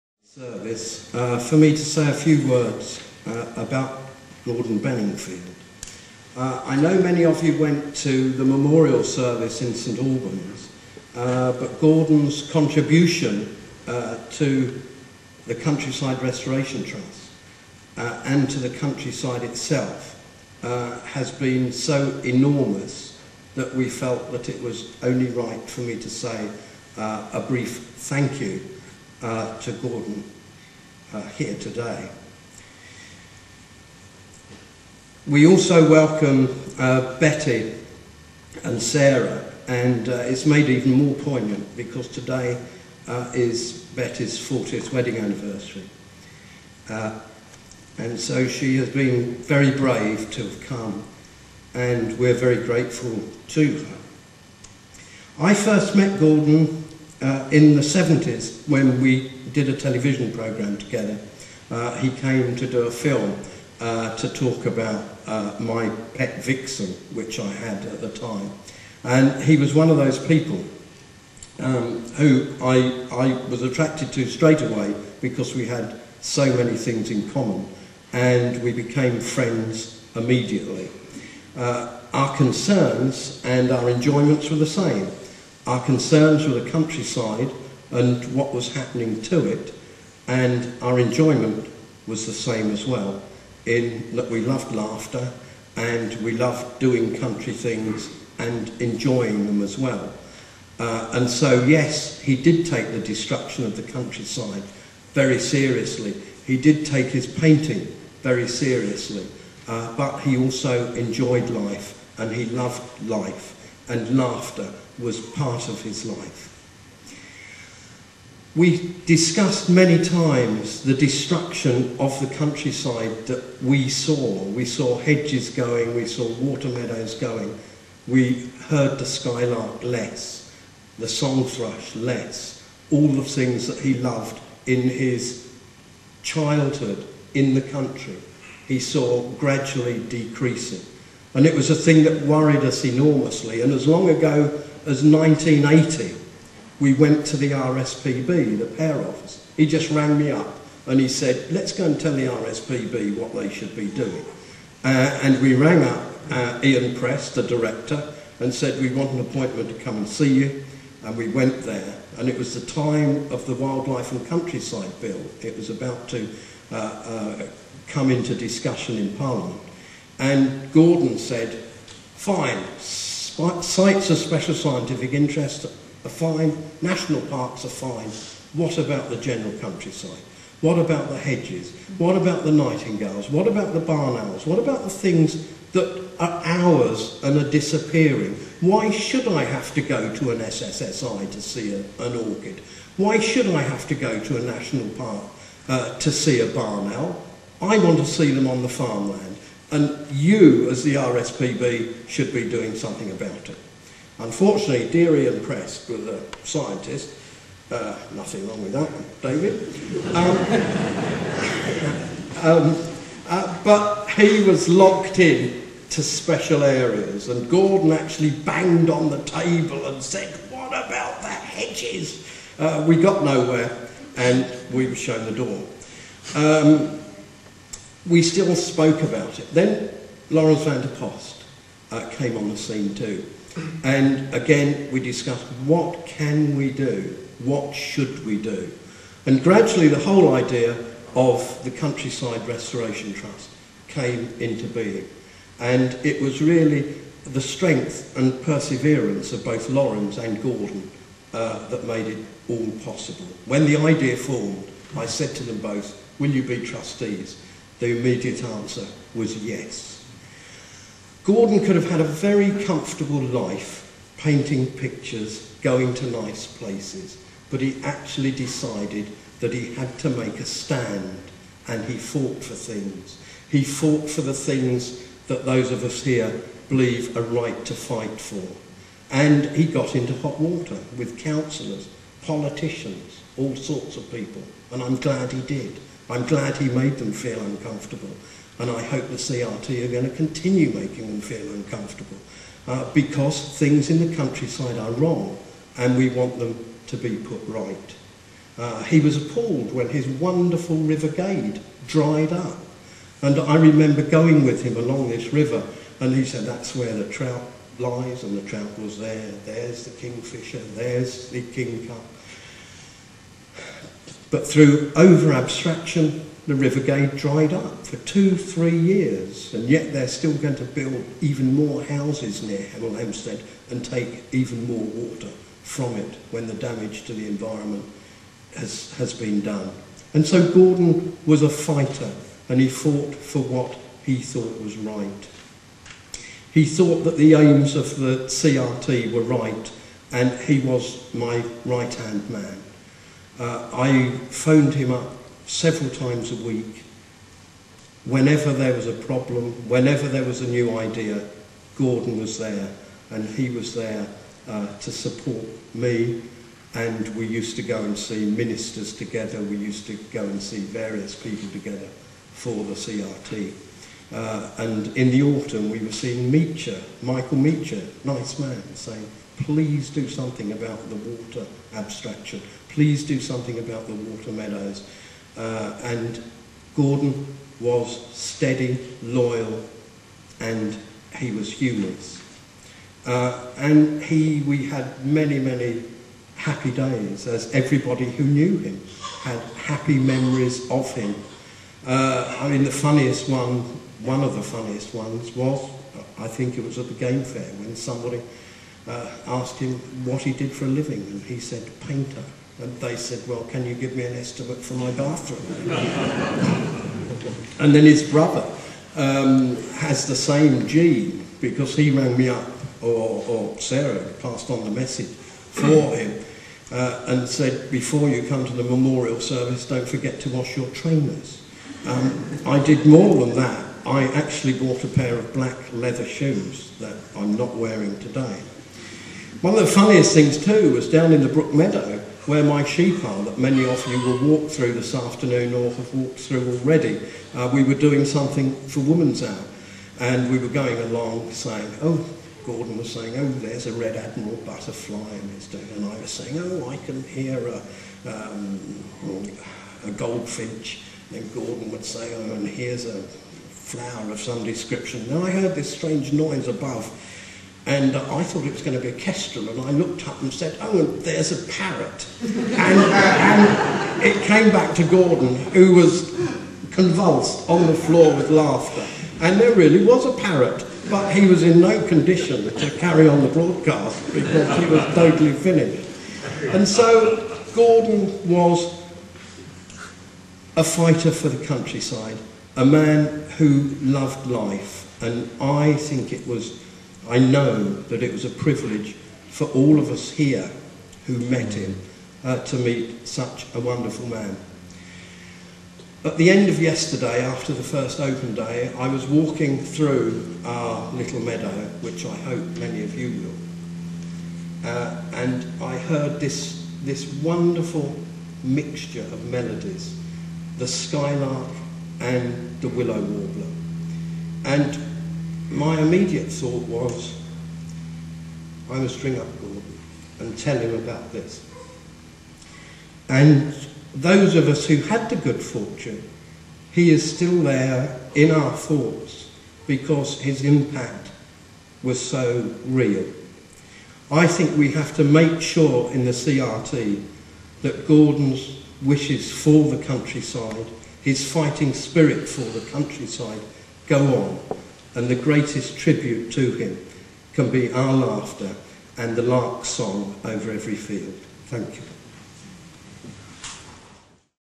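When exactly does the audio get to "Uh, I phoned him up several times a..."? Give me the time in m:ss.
5:43.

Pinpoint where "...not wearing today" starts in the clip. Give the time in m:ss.
7:07.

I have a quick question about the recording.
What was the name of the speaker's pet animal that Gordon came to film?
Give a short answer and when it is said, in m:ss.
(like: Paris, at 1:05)
Vixen, at 1:06.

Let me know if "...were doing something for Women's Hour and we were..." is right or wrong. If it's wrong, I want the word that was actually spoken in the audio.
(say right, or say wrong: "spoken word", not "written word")
right.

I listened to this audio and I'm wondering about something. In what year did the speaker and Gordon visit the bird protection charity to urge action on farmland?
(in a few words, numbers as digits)
1980.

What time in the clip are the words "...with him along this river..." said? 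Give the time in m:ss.
5:04.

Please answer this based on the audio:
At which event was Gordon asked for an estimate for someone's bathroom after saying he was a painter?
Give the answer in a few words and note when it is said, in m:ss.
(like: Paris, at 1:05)
The game fair, at 6:36.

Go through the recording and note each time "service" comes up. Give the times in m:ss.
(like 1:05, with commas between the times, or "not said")
0:00, 0:09, 6:59.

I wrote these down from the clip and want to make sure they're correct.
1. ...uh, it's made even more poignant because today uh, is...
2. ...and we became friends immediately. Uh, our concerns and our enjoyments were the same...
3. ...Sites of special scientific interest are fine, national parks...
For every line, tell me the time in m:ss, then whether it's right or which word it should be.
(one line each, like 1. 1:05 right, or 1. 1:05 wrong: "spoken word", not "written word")
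1. 0:40 right
2. 1:18 right
3. 2:53 right.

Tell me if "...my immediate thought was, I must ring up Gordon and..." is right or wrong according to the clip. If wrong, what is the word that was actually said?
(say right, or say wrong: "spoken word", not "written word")
right.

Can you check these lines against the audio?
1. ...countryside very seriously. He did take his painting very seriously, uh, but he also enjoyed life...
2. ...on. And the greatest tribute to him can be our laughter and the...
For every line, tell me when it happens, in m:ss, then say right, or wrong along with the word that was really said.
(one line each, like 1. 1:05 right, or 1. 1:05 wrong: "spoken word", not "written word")
1. 1:43 right
2. 9:04 right.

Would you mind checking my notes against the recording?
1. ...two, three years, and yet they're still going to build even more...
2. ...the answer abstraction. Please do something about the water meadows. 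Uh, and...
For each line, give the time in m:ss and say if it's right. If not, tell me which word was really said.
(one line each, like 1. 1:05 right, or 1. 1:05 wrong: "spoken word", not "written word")
1. 5:17 right
2. 6:10 wrong: "water", not "answer".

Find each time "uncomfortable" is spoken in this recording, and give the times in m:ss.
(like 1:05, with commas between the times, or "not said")
4:47, 4:51.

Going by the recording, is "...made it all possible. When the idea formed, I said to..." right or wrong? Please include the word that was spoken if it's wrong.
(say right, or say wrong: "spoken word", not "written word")
right.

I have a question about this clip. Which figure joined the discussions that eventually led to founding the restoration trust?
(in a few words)
Laurens van der Post.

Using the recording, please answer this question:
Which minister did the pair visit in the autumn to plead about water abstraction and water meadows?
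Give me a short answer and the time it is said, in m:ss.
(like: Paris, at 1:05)
Michael Meacher, at 6:07.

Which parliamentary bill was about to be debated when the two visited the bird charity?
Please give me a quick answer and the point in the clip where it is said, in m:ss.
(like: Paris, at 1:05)
Wildlife and Countryside Bill, at 2:43.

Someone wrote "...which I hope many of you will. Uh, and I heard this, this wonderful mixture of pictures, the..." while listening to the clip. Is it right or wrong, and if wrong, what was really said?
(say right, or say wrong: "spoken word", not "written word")
wrong: "melodies", not "pictures".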